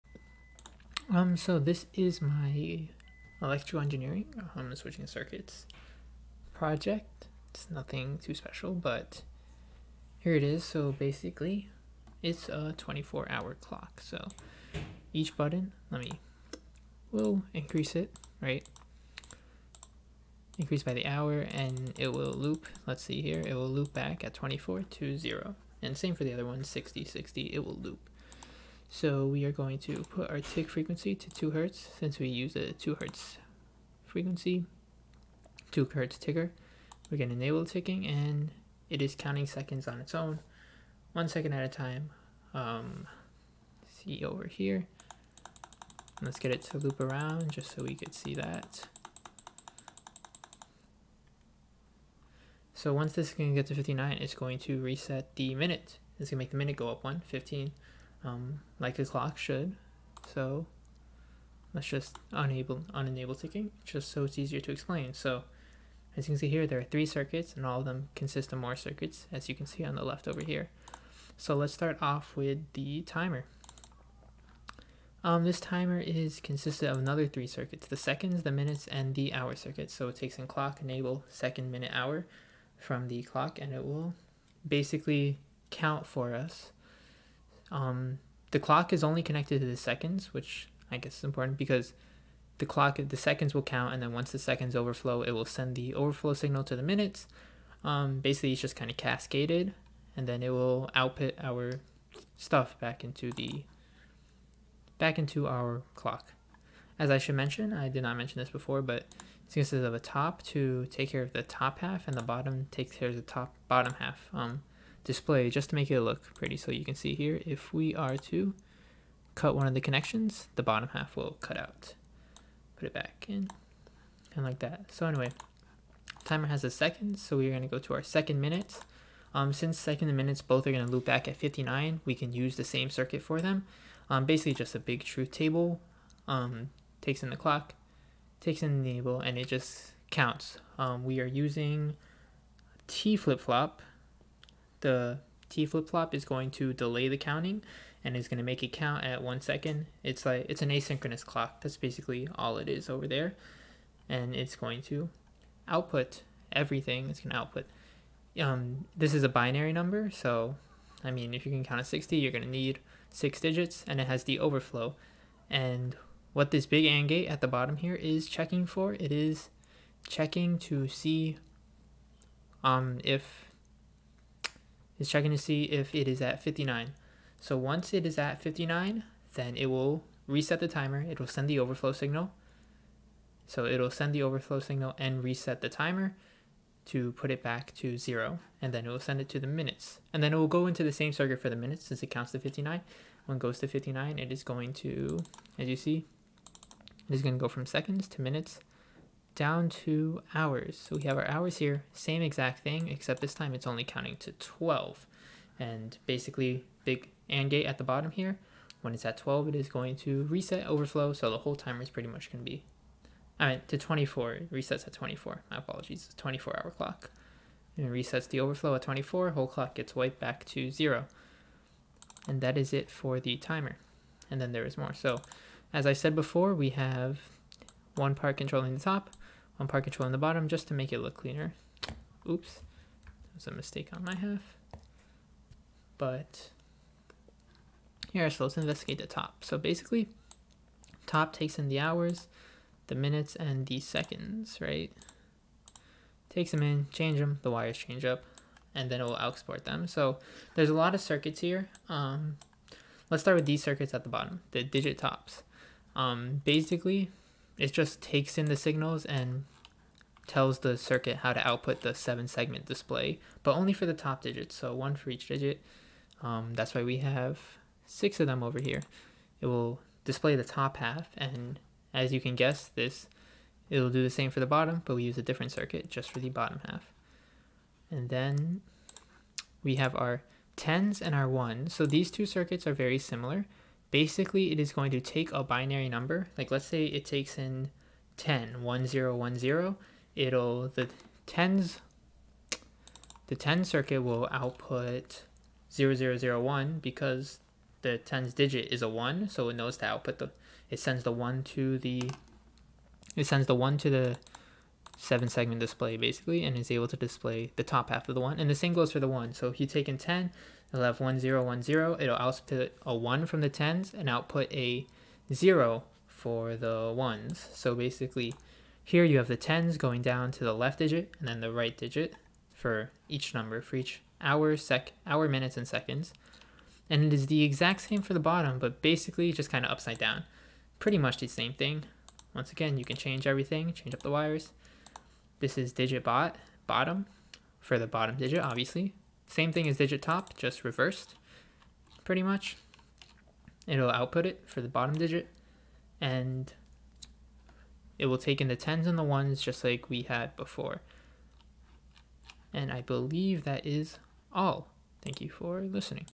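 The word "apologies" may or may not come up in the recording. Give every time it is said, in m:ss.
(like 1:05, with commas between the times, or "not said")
3:35.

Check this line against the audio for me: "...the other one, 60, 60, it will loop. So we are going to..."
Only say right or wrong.
right.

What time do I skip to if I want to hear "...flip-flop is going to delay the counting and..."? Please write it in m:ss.
2:25.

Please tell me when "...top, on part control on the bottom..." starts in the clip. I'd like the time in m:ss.
3:48.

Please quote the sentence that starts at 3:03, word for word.
So it'll send the overflow signal and reset the timer to put it back to zero.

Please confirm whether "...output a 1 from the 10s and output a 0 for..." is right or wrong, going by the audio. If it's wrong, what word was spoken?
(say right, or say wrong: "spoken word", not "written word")
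right.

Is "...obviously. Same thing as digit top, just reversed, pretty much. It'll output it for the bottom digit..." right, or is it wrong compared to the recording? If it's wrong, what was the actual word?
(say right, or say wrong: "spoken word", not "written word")
right.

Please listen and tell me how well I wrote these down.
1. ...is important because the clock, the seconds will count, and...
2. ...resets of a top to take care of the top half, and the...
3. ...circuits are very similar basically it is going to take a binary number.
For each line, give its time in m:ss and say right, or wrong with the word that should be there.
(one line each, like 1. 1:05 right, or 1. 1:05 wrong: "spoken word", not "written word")
1. 1:31 right
2. 1:49 wrong: "consists", not "resets"
3. 4:42 right.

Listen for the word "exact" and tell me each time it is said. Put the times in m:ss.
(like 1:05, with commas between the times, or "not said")
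3:22, 5:27.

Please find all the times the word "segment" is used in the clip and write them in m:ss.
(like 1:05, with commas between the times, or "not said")
4:22, 5:05.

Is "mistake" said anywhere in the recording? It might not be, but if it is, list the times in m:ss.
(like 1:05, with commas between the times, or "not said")
3:53.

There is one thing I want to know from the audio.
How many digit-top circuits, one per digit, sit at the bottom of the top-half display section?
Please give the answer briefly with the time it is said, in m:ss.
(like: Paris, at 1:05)
6, at 4:27.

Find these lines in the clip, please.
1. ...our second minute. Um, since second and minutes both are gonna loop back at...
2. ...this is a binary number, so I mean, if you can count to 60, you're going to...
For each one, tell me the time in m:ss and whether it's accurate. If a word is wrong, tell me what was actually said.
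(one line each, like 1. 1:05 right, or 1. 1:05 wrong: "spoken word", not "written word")
1. 2:07 right
2. 2:38 right.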